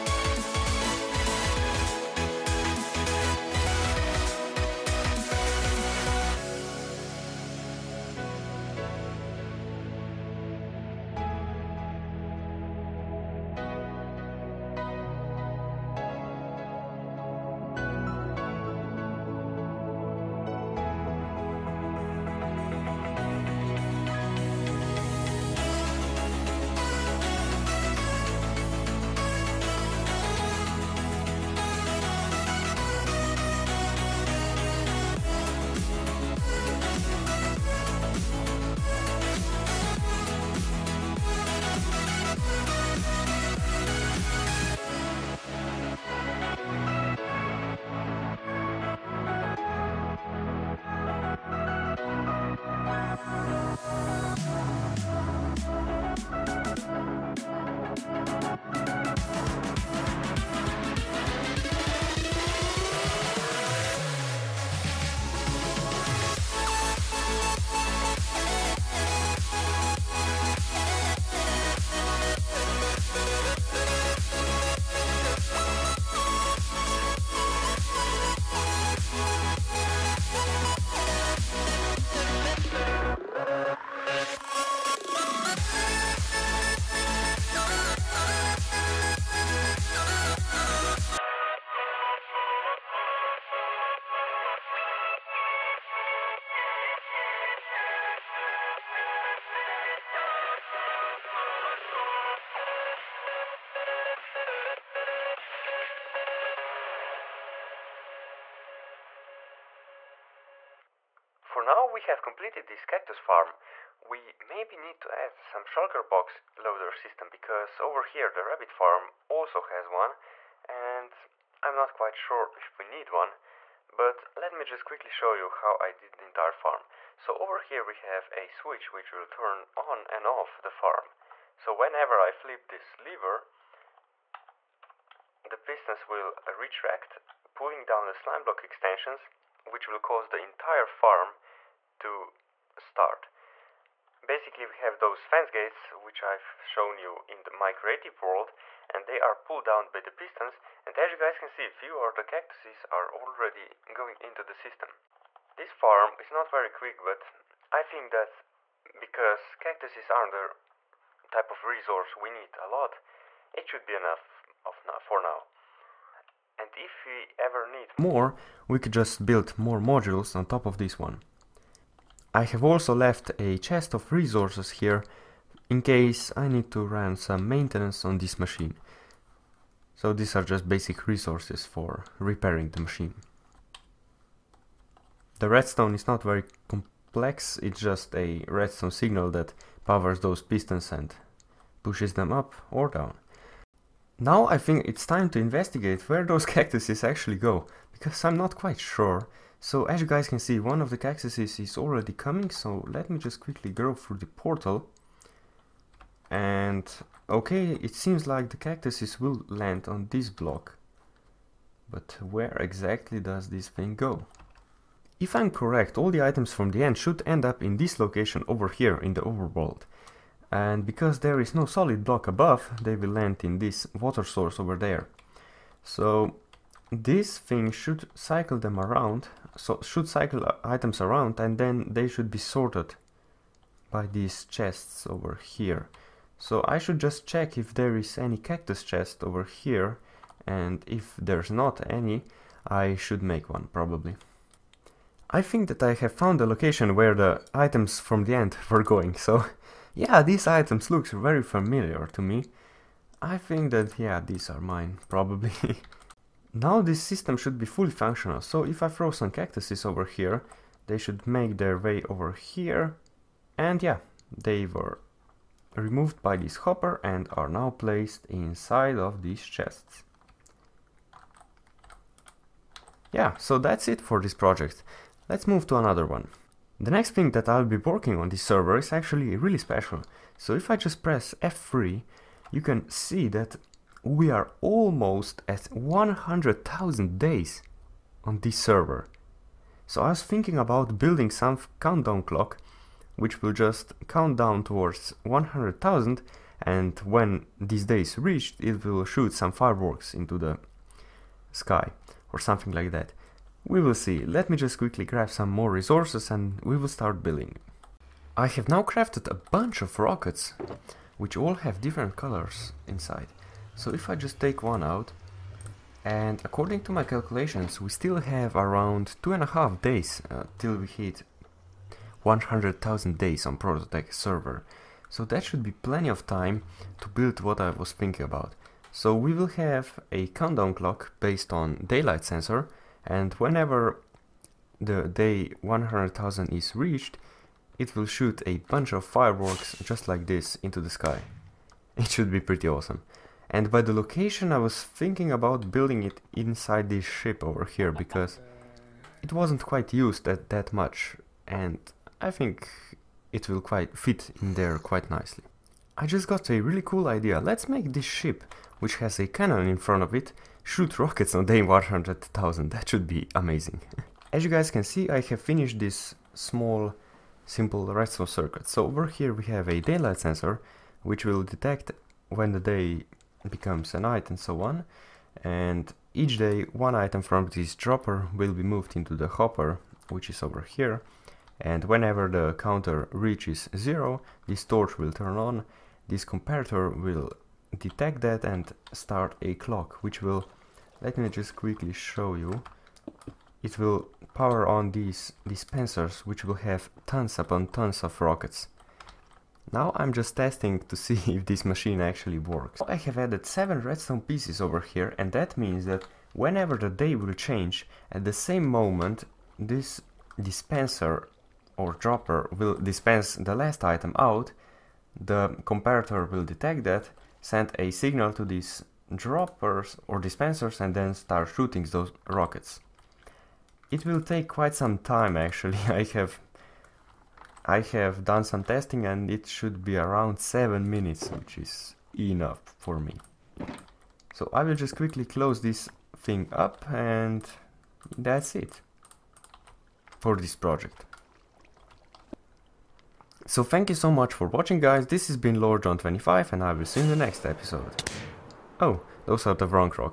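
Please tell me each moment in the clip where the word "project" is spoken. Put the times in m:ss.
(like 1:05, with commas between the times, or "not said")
4:34, 7:20.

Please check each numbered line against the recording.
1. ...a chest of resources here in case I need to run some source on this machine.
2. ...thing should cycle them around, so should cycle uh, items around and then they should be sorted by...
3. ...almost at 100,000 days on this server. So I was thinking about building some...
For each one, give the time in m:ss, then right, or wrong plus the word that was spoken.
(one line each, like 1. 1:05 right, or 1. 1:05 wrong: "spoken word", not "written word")
1. 2:53 wrong: "maintenance", not "source"
2. 3:47 right
3. 4:44 right.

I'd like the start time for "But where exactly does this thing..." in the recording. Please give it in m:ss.
3:31.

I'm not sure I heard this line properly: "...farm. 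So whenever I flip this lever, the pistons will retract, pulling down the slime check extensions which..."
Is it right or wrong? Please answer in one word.
wrong.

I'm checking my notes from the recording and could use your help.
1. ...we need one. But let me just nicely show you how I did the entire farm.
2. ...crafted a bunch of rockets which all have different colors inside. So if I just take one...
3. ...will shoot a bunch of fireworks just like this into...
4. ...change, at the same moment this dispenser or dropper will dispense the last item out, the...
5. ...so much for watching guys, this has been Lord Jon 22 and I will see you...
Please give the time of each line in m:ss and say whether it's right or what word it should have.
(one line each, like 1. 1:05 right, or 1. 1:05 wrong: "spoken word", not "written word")
1. 2:02 wrong: "quickly", not "nicely"
2. 5:08 right
3. 5:37 right
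4. 6:47 right
5. 7:23 wrong: "25", not "22".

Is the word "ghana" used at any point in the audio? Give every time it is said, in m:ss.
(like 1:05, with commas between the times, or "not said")
not said.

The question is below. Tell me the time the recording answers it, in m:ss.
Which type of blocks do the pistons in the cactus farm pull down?
2:25.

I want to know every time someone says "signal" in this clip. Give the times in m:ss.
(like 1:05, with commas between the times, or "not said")
3:08, 6:57.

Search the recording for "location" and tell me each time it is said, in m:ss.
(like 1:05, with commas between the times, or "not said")
3:37, 4:06, 5:43.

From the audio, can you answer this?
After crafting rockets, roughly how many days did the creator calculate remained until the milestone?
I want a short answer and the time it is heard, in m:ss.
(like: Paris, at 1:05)
Two and a half, at 5:19.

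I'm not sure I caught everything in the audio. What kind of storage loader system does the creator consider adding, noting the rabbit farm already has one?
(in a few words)
Shulker box loader.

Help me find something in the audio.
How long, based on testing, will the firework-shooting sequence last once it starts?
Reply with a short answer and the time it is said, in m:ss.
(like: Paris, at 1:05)
7 minutes, at 7:10.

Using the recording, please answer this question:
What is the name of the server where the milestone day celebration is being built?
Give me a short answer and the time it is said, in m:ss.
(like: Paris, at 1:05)
Prototech, at 5:23.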